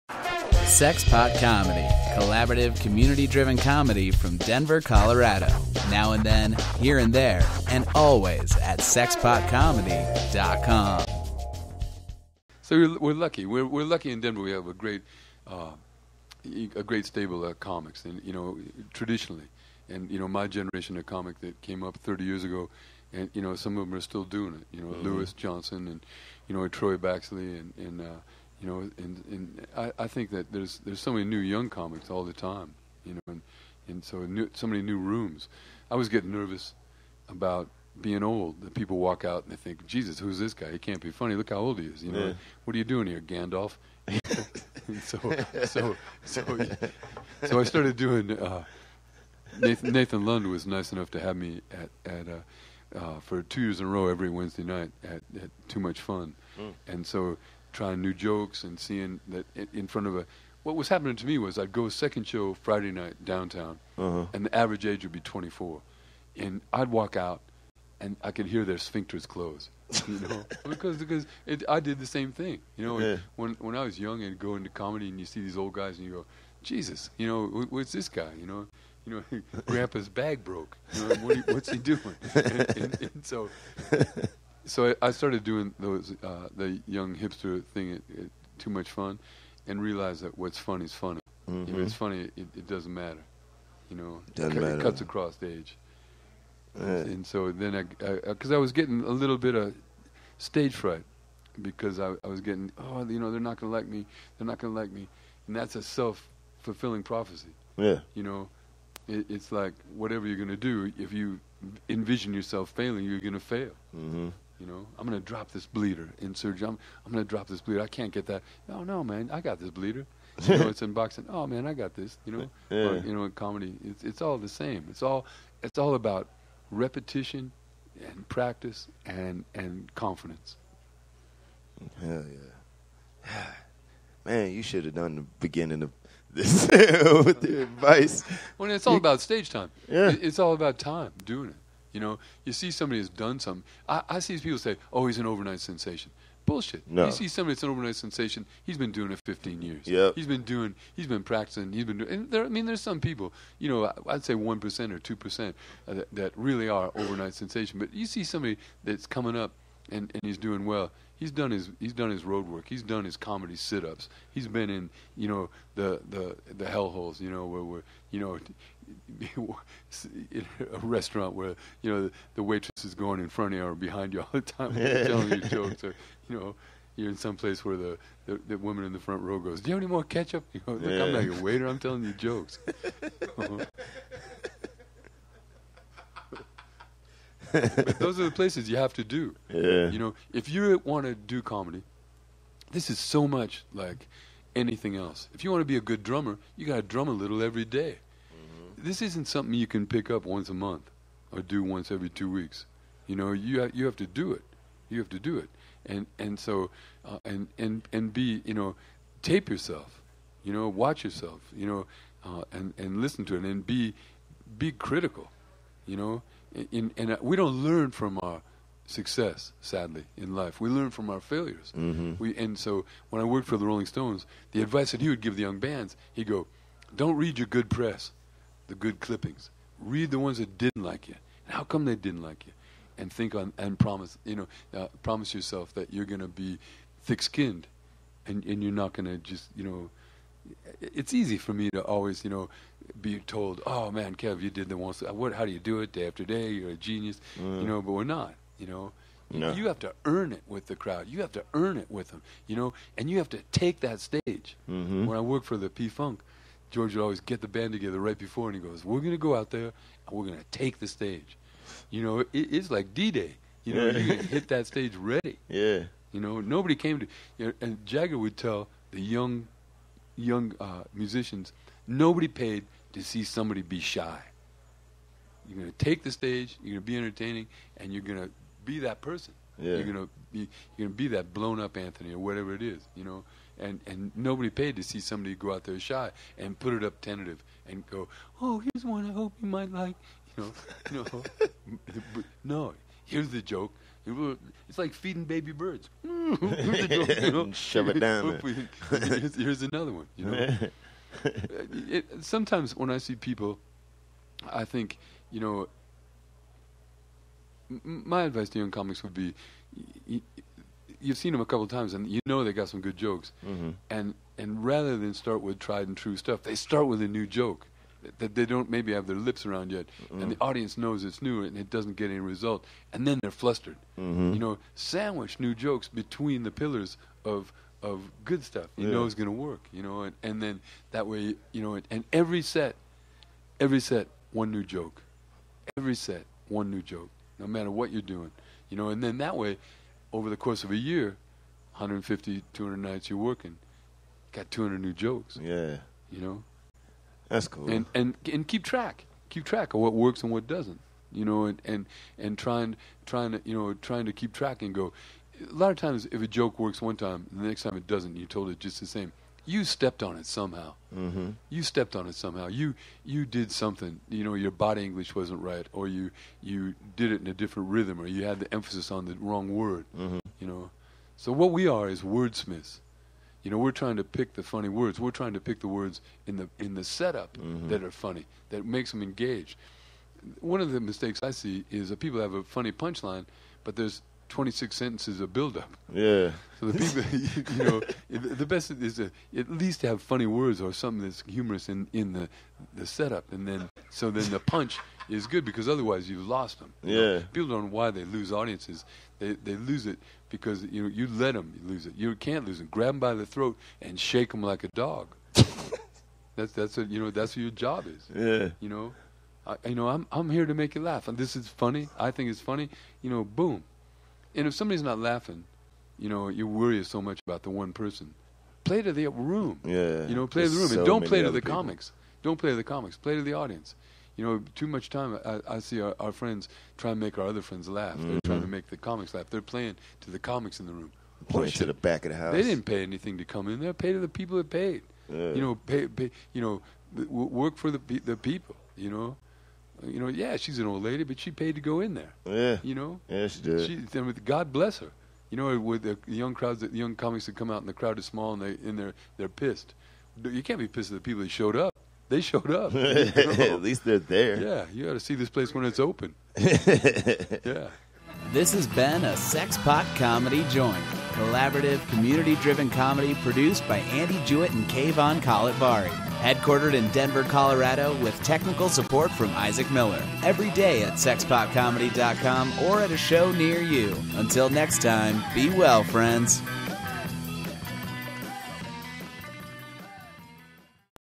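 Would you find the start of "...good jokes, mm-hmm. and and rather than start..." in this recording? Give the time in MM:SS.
05:12.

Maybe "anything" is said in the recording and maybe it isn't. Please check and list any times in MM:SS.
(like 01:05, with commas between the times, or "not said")
03:14, 07:12.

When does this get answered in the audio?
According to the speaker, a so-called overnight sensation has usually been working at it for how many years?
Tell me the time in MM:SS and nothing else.
02:29.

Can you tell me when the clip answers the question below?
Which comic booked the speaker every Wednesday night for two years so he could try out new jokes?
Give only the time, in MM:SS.
00:49.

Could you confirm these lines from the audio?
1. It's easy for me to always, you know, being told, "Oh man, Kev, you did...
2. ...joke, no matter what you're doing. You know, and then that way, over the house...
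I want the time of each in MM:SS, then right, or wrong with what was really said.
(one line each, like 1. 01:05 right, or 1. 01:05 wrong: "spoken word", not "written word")
1. 04:00 right
2. 05:36 wrong: "course", not "house".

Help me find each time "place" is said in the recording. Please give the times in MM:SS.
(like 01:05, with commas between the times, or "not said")
02:57, 03:08, 07:35.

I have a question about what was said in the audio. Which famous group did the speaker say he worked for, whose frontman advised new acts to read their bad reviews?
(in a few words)
the Rolling Stones.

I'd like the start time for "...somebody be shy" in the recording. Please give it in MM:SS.
04:33.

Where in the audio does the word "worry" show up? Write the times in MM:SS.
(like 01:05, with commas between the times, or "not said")
06:56.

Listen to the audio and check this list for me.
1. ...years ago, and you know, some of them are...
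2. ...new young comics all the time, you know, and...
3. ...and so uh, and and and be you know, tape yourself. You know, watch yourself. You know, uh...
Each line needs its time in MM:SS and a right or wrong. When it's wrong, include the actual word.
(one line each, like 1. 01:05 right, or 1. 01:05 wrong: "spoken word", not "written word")
1. 00:22 right
2. 00:31 right
3. 03:26 right.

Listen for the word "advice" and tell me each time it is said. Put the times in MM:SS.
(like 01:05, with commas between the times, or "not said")
02:17, 03:44, 05:08.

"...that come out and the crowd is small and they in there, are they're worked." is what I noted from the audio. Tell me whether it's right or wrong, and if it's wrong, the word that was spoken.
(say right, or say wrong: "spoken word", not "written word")
wrong: "pissed", not "worked".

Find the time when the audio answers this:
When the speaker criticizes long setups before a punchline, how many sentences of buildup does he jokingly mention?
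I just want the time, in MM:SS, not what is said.
06:24.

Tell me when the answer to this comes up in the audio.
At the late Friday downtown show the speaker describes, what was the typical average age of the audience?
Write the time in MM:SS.
01:05.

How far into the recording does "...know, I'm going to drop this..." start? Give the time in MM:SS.
01:54.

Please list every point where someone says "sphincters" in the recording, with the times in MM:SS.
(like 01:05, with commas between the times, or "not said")
01:08.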